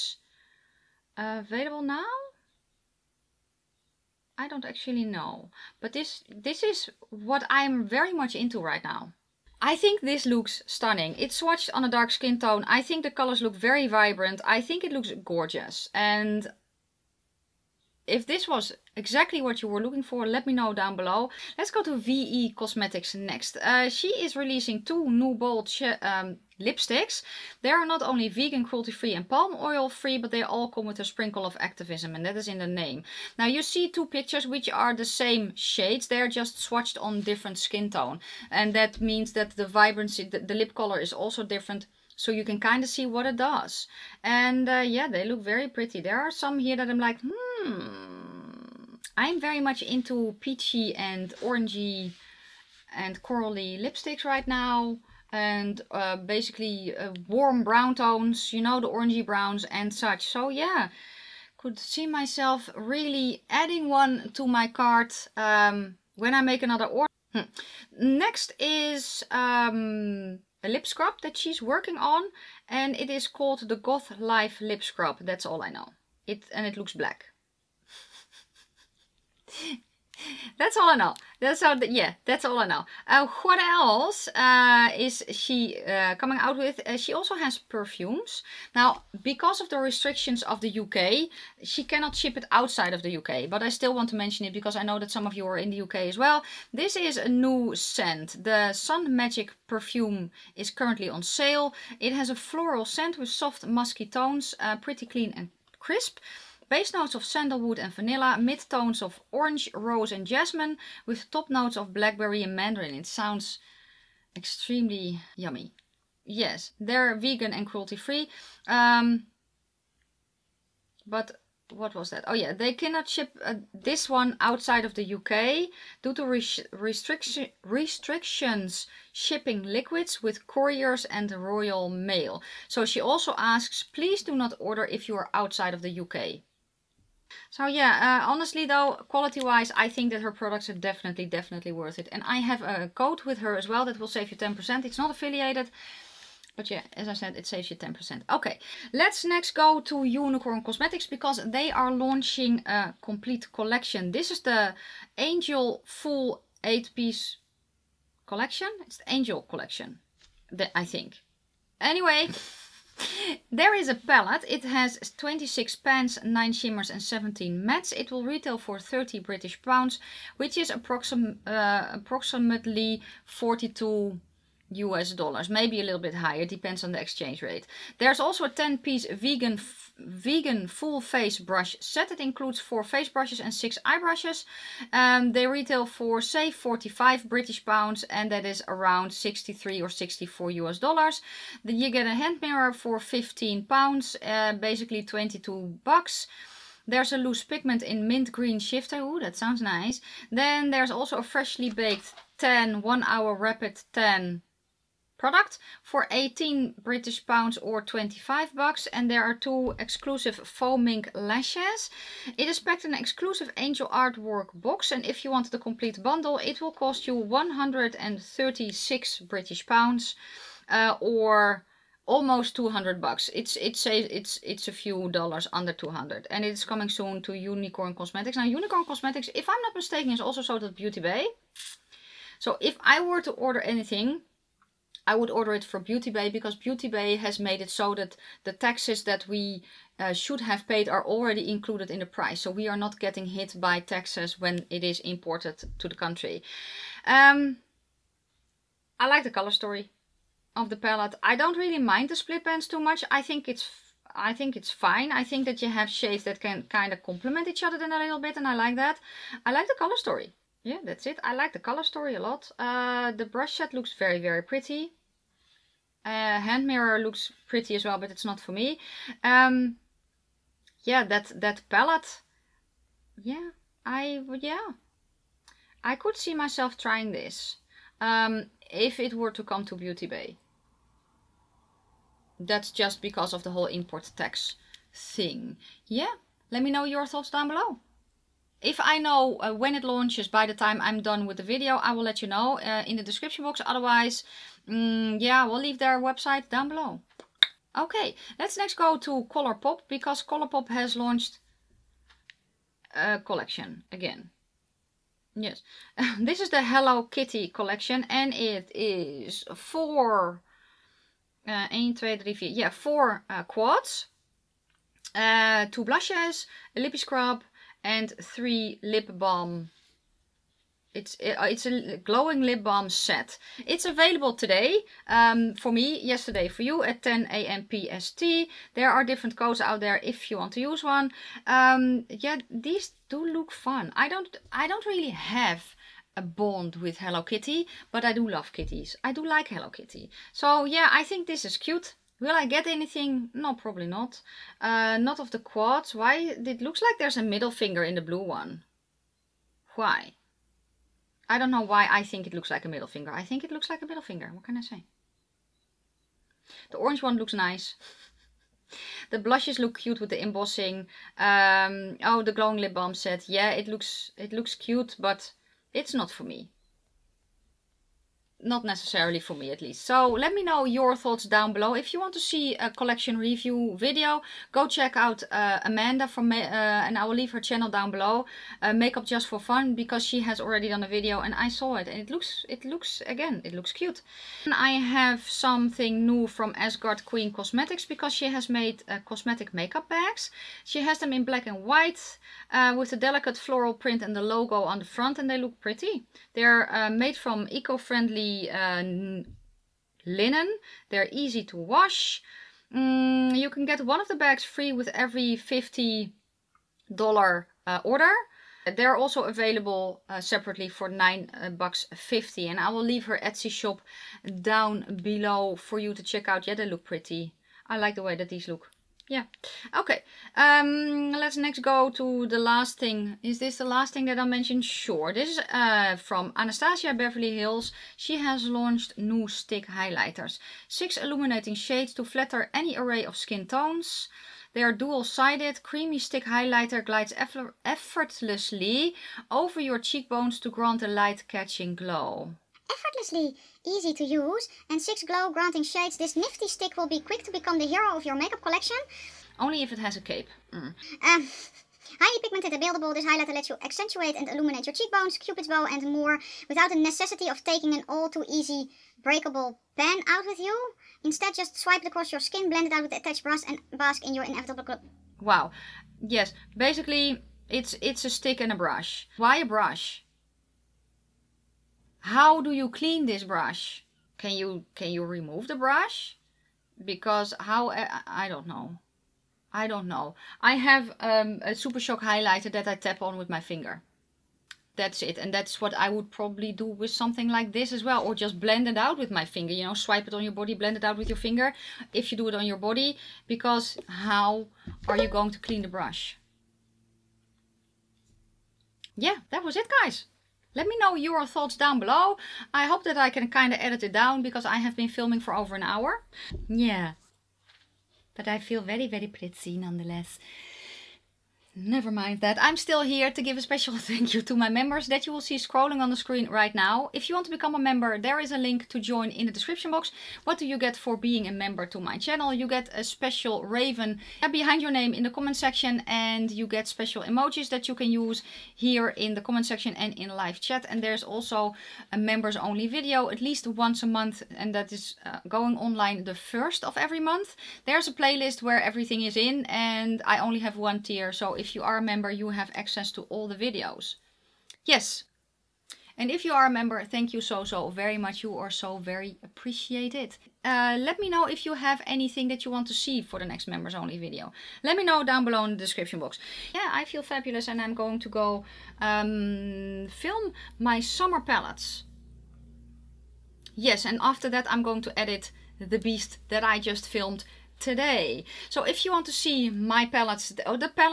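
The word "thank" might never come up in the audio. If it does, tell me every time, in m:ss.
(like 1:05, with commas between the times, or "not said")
8:33, 9:06.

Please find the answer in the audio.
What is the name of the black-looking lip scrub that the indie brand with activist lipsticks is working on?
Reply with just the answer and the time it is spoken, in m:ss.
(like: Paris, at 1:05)
Goth Life Lip Scrub, at 1:13.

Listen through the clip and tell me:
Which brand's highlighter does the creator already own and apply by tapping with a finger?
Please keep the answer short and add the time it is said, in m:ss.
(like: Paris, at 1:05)
Super Shock, at 8:01.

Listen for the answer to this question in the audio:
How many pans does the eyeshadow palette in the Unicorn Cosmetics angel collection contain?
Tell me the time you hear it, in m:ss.
2:45.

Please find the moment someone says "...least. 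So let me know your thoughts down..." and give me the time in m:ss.
6:09.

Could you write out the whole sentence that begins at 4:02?
So we are not getting hit by taxes when it is imported to the country.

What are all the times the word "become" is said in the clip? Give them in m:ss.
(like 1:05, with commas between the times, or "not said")
7:27, 8:37.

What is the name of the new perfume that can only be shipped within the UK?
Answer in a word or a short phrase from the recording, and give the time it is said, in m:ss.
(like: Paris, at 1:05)
Sun Magic, at 1:38.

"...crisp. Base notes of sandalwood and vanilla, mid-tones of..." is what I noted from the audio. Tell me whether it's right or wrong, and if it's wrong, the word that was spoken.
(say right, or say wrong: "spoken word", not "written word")
right.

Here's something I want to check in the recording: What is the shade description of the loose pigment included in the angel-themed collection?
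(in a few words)
mint green shifter.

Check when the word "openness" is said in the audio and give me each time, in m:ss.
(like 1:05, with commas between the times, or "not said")
not said.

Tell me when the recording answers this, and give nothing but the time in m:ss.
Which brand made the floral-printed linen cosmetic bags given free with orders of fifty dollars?
6:26.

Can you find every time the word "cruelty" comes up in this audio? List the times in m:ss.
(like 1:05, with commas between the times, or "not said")
0:28, 1:57.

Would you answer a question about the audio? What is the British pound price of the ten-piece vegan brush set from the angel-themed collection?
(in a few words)
45 British pounds.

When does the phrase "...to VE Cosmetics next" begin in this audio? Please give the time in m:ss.
0:21.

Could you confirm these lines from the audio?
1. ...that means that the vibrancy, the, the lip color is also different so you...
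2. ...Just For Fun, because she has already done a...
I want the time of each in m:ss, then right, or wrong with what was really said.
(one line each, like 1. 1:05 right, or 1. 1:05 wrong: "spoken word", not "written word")
1. 0:38 right
2. 6:19 right.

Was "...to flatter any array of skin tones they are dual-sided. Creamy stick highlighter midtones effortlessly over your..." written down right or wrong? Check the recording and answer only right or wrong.
wrong.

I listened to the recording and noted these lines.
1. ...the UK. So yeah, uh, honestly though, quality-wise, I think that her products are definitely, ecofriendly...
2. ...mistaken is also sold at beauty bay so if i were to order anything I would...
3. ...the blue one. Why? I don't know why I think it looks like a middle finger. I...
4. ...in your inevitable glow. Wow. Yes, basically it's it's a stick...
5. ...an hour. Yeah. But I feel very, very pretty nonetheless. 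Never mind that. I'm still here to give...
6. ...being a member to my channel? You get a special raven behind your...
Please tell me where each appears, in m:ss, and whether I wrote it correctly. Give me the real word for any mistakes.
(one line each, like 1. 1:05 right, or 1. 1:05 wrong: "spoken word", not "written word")
1. 2:15 wrong: "definitely", not "ecofriendly"
2. 3:49 right
3. 5:47 right
4. 7:44 right
5. 8:25 right
6. 8:40 right.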